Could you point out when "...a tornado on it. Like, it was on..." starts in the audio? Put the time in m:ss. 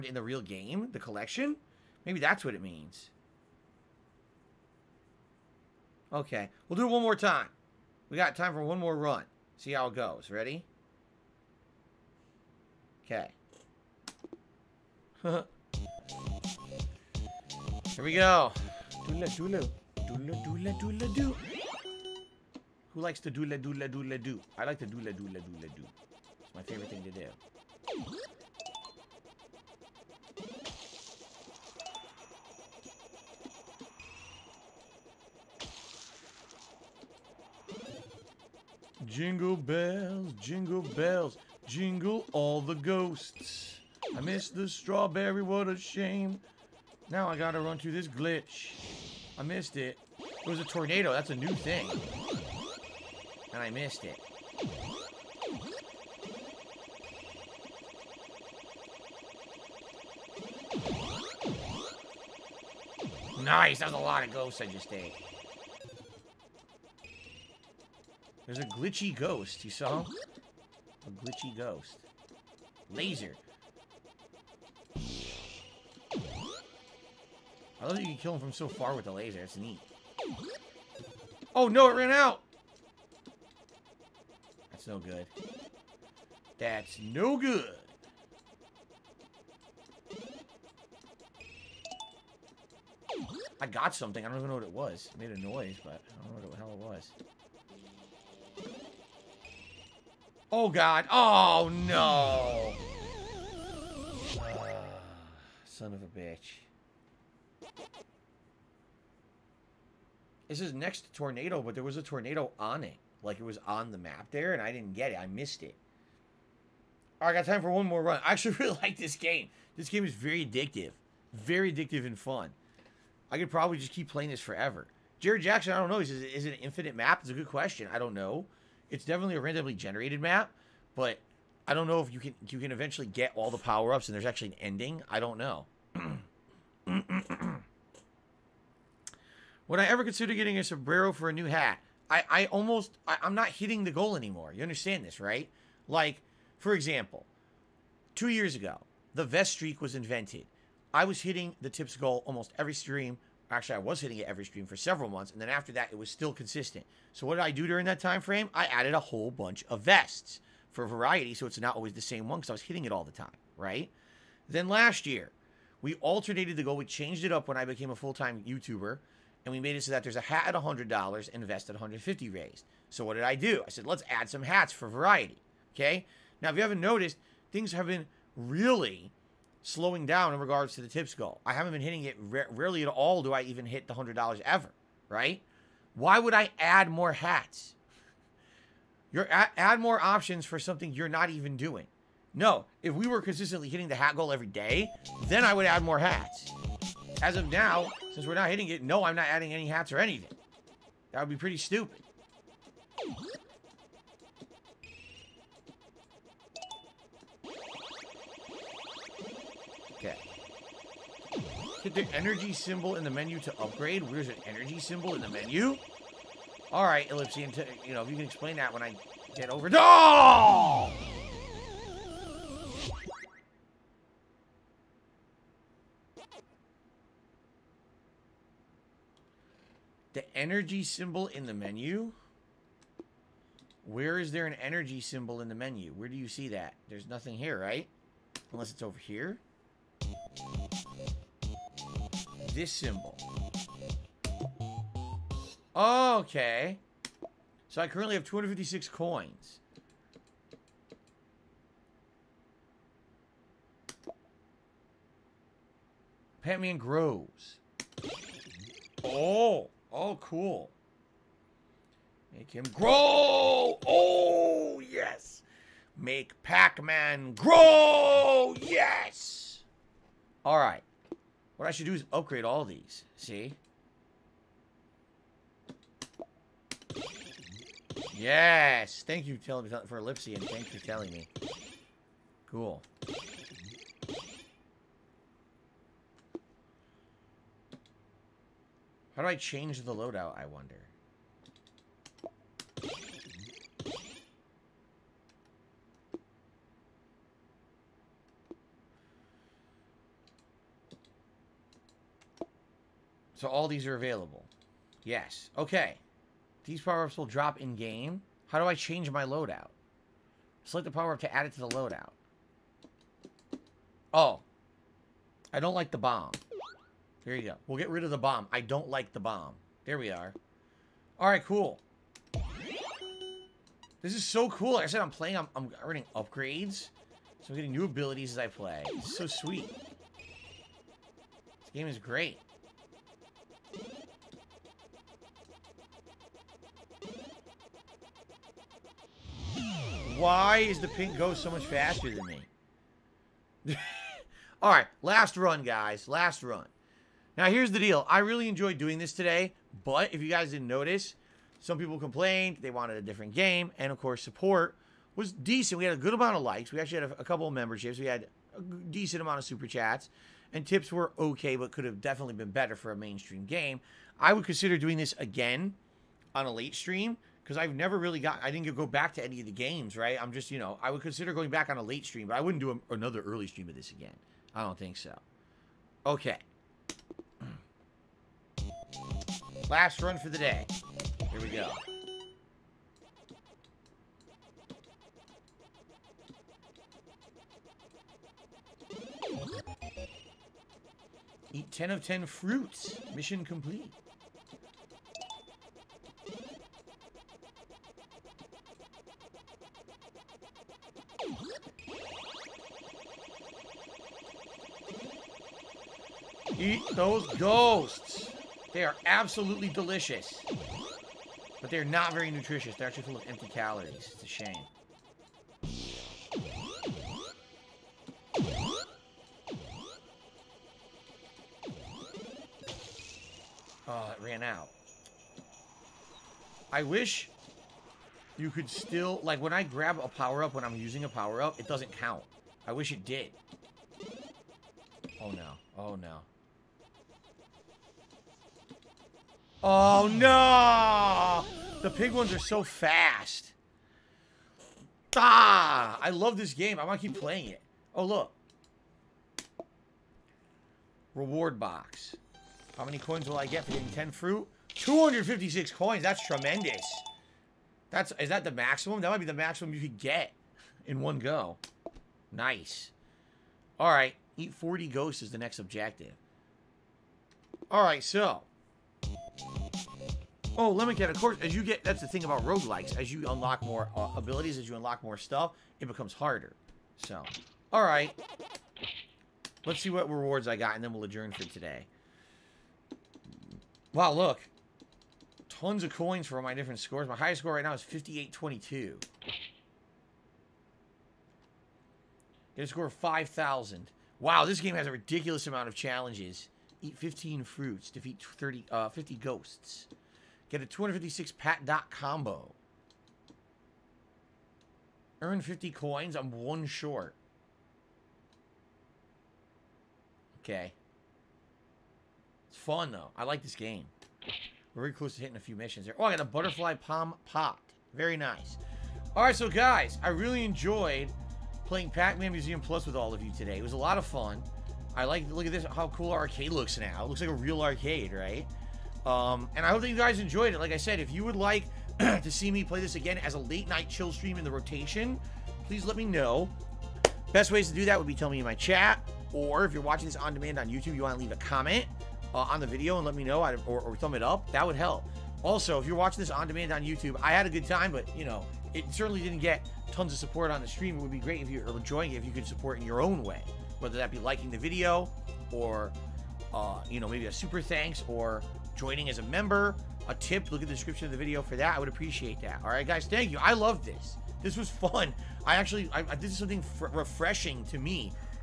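1:51.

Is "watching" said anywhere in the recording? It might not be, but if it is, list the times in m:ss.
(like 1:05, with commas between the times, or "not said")
8:59, 9:05.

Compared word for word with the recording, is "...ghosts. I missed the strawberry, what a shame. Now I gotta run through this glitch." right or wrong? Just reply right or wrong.
right.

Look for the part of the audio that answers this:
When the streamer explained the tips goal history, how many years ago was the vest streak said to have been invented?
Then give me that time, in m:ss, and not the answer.
2:28.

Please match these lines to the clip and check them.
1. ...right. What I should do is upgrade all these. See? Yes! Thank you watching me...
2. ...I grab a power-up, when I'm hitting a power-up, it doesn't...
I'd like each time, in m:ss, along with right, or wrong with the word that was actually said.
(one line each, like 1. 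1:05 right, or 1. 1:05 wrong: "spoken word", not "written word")
1. 4:30 wrong: "telling", not "watching"
2. 7:09 wrong: "using", not "hitting".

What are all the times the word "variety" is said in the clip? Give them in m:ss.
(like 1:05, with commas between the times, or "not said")
2:40, 2:54.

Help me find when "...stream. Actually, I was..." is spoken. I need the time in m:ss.
2:32.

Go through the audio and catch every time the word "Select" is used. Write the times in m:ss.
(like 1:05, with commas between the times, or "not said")
5:10.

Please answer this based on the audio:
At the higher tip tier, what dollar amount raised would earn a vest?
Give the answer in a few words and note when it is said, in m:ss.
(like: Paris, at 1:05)
150, at 2:51.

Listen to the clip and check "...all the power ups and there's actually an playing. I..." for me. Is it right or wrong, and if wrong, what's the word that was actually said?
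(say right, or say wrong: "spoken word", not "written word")
wrong: "ending", not "playing".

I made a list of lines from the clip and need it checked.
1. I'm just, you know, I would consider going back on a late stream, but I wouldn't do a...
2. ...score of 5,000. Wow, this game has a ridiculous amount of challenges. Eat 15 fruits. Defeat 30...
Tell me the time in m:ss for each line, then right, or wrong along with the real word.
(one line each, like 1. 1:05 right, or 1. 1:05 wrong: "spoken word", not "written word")
1. 6:10 right
2. 8:12 right.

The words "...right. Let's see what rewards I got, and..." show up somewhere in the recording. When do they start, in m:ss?
7:57.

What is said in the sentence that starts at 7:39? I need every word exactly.
That might be the maximum you could get in one go.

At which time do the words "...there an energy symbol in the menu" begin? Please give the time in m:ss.
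3:54.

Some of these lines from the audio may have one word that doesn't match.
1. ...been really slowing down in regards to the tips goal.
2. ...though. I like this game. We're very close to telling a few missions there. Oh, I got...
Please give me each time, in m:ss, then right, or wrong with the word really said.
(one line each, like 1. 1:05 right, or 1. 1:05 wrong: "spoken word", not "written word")
1. 2:57 right
2. 8:32 wrong: "hitting", not "telling".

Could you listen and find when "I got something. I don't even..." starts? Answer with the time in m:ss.
1:33.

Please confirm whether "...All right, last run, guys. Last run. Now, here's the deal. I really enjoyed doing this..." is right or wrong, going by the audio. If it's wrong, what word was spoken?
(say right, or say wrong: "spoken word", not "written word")
right.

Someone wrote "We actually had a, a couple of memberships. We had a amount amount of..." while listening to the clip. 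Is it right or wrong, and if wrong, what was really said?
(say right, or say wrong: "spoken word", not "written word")
wrong: "decent", not "amount".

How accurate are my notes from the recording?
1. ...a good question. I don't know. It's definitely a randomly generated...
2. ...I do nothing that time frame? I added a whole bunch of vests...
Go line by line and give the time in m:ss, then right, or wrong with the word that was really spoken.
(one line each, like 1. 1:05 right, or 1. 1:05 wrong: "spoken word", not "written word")
1. 2:07 right
2. 2:37 wrong: "during", not "nothing".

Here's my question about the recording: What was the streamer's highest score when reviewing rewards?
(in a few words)
5822.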